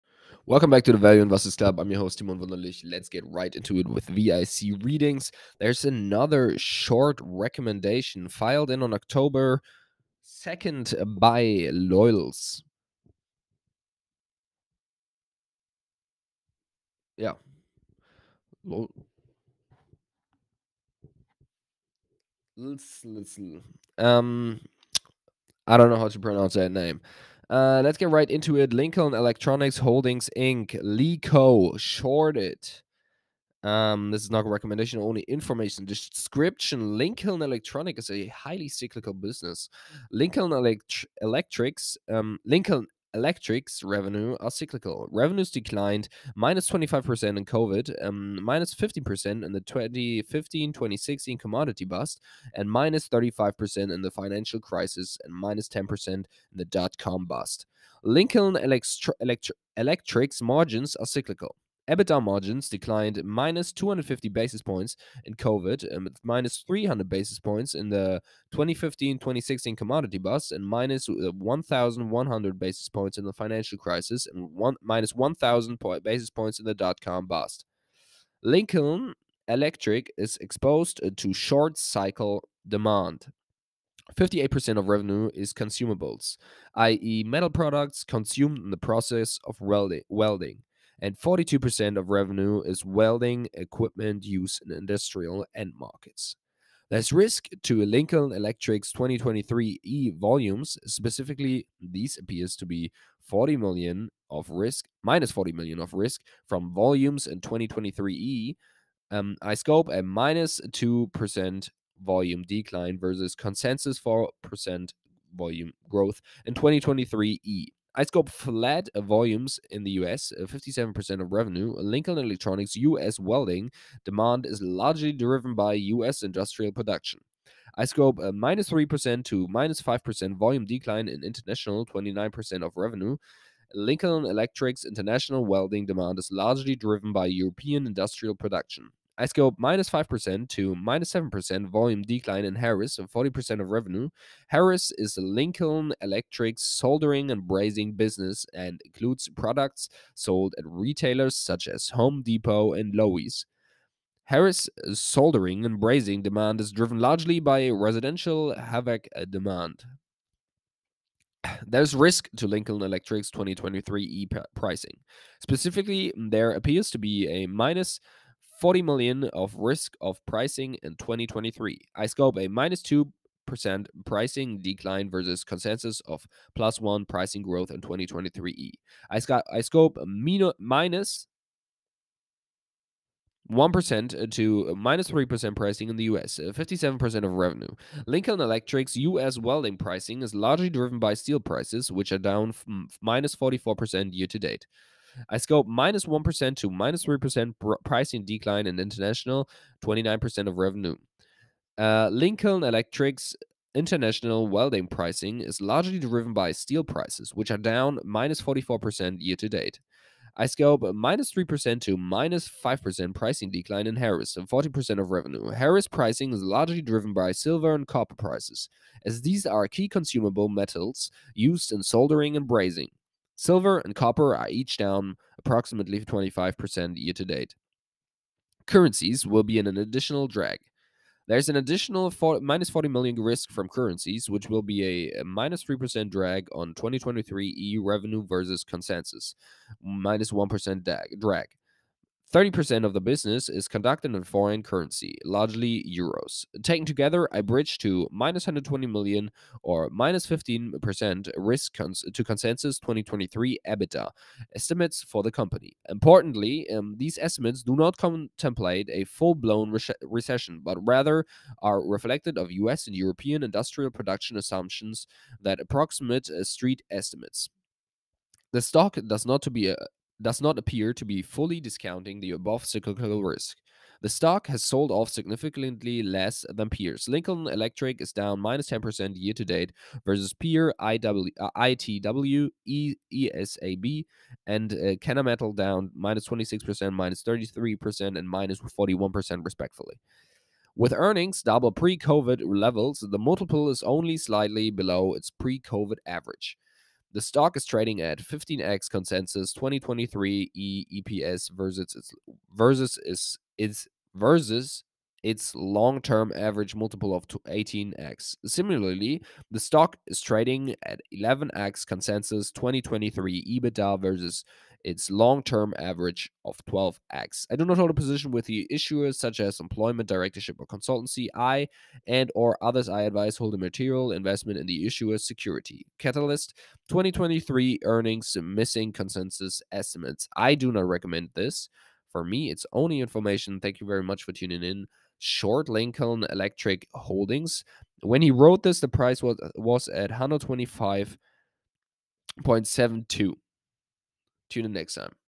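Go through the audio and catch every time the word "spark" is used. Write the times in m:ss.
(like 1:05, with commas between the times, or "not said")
not said.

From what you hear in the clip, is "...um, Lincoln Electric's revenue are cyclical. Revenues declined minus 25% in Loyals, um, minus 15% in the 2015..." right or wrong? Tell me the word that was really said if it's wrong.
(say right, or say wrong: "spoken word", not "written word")
wrong: "COVID", not "Loyals".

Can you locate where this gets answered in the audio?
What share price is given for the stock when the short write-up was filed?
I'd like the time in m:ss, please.
5:40.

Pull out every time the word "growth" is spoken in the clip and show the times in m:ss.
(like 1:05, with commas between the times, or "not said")
1:55, 2:57.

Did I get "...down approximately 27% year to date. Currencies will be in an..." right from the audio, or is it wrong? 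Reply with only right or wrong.
wrong.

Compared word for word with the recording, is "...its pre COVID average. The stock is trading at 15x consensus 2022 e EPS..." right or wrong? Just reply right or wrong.
wrong.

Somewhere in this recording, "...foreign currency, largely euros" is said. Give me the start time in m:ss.
4:04.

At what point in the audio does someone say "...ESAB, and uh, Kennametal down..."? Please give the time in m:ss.
4:43.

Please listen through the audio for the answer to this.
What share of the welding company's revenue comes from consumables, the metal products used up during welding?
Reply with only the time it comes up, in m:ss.
1:24.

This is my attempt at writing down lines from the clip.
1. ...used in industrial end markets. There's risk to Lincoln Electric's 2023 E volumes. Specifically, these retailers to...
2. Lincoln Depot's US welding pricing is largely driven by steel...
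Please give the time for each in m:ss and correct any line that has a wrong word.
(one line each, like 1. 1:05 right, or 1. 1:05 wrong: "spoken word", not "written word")
1. 1:34 wrong: "appears", not "retailers"
2. 3:08 wrong: "Electric", not "Depot".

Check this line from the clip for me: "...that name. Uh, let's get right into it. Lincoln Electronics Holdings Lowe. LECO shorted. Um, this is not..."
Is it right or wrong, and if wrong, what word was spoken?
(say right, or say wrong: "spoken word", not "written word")
wrong: "Inc", not "Lowe".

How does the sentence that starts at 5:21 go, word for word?
I and or others I advise hold a material investment in the issuer's security.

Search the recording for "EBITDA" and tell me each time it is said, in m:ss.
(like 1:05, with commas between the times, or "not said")
1:01, 4:13, 5:13.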